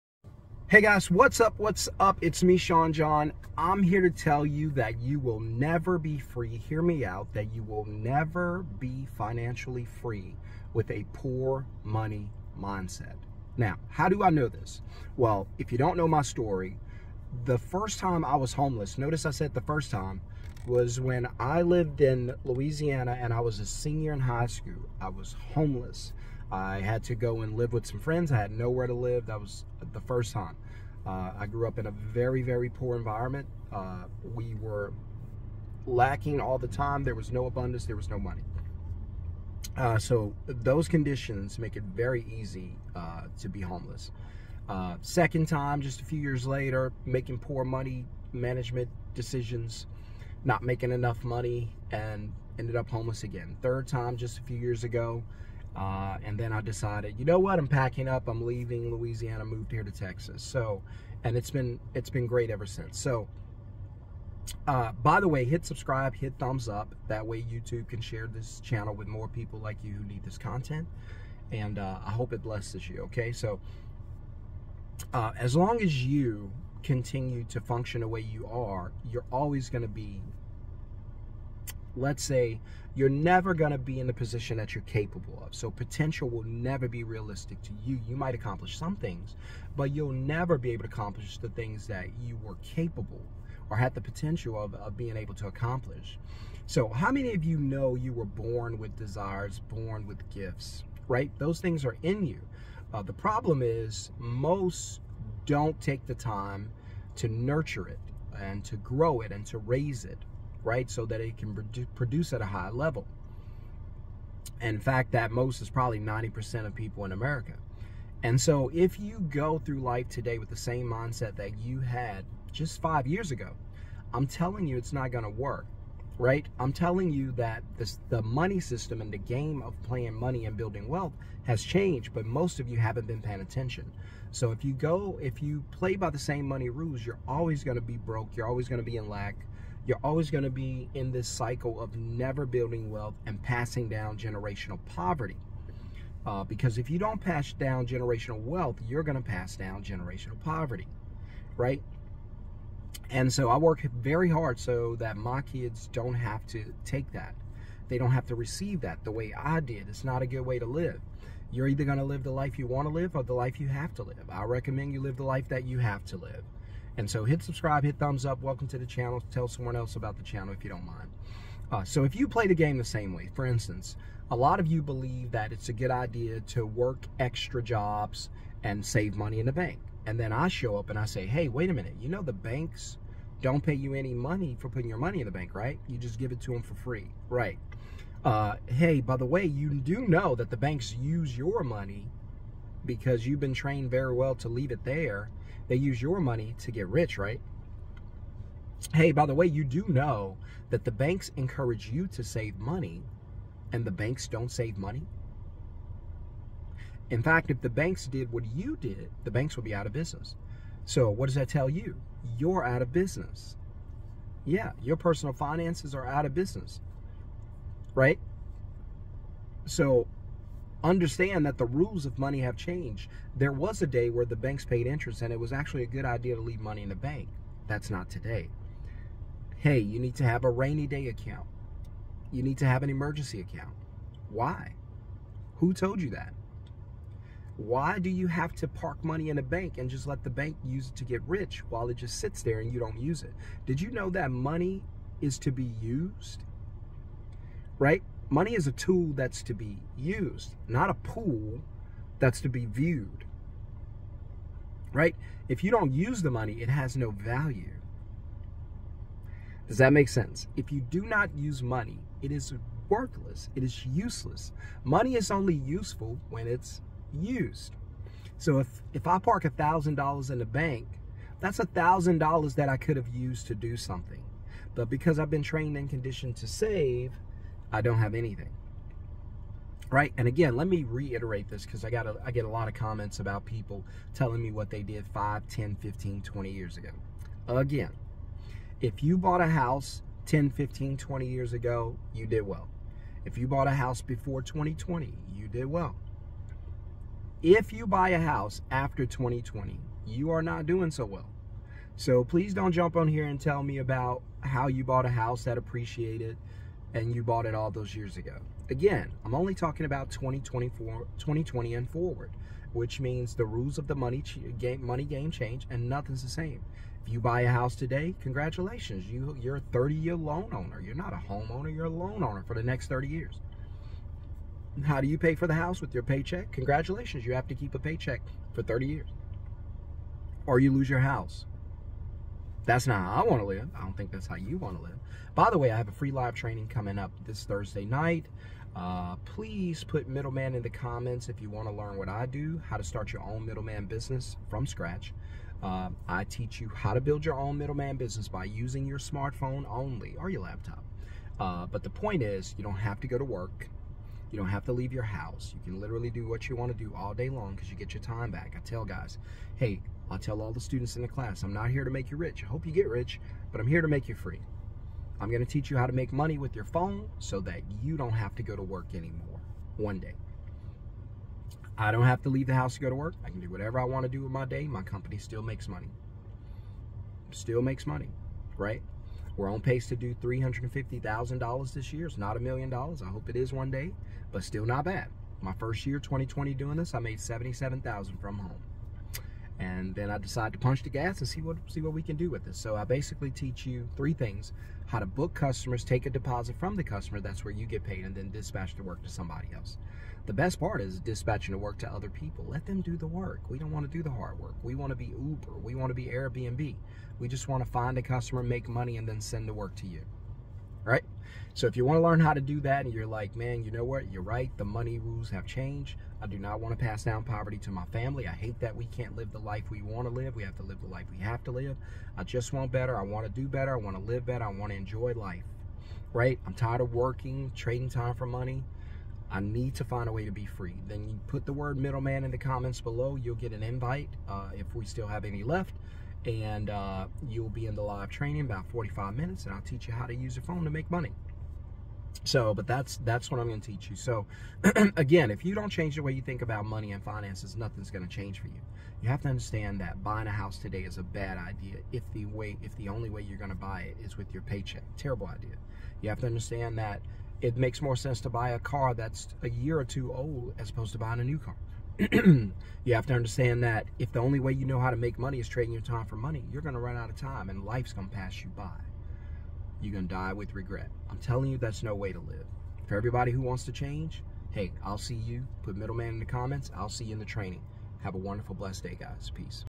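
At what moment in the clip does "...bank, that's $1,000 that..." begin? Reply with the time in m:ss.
4:30.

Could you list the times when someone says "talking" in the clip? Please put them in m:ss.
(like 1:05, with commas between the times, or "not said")
5:09.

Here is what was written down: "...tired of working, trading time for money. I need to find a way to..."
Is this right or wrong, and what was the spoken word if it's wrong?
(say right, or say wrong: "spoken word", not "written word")
right.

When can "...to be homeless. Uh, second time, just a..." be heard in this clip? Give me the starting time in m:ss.
0:43.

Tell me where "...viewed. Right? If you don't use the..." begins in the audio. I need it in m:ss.
4:12.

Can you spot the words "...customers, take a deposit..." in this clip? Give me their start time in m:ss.
6:35.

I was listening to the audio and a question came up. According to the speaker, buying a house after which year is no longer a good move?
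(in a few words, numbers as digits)
2020.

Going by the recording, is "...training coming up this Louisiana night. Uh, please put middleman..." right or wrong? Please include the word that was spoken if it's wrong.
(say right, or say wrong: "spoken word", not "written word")
wrong: "Thursday", not "Louisiana".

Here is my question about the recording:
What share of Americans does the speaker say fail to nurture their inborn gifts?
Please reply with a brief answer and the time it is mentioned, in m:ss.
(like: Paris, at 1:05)
90%, at 1:55.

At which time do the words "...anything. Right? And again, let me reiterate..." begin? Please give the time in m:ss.
4:38.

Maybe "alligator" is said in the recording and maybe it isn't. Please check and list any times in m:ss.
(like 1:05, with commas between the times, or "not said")
not said.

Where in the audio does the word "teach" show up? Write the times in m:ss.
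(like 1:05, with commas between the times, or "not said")
5:46, 6:05, 6:33, 7:19, 7:23.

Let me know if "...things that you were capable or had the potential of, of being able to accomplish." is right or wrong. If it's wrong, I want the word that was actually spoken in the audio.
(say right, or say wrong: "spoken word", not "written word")
right.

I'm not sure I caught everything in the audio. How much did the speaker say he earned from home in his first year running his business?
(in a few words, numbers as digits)
77,000.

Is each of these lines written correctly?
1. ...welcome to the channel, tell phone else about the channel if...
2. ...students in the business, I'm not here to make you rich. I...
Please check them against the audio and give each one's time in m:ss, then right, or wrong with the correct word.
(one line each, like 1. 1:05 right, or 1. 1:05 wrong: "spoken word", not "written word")
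1. 2:48 wrong: "someone", not "phone"
2. 6:00 wrong: "class", not "business".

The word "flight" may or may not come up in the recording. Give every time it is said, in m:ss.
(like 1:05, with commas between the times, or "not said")
not said.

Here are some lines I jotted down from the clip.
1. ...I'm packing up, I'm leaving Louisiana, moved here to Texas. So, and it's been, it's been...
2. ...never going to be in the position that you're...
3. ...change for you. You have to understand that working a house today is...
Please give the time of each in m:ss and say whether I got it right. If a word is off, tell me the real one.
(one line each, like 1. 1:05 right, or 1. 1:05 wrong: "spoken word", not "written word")
1. 0:57 right
2. 1:23 right
3. 7:28 wrong: "buying", not "working".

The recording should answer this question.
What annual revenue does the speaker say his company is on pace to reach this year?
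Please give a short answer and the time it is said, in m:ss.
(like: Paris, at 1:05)
$350,000, at 6:20.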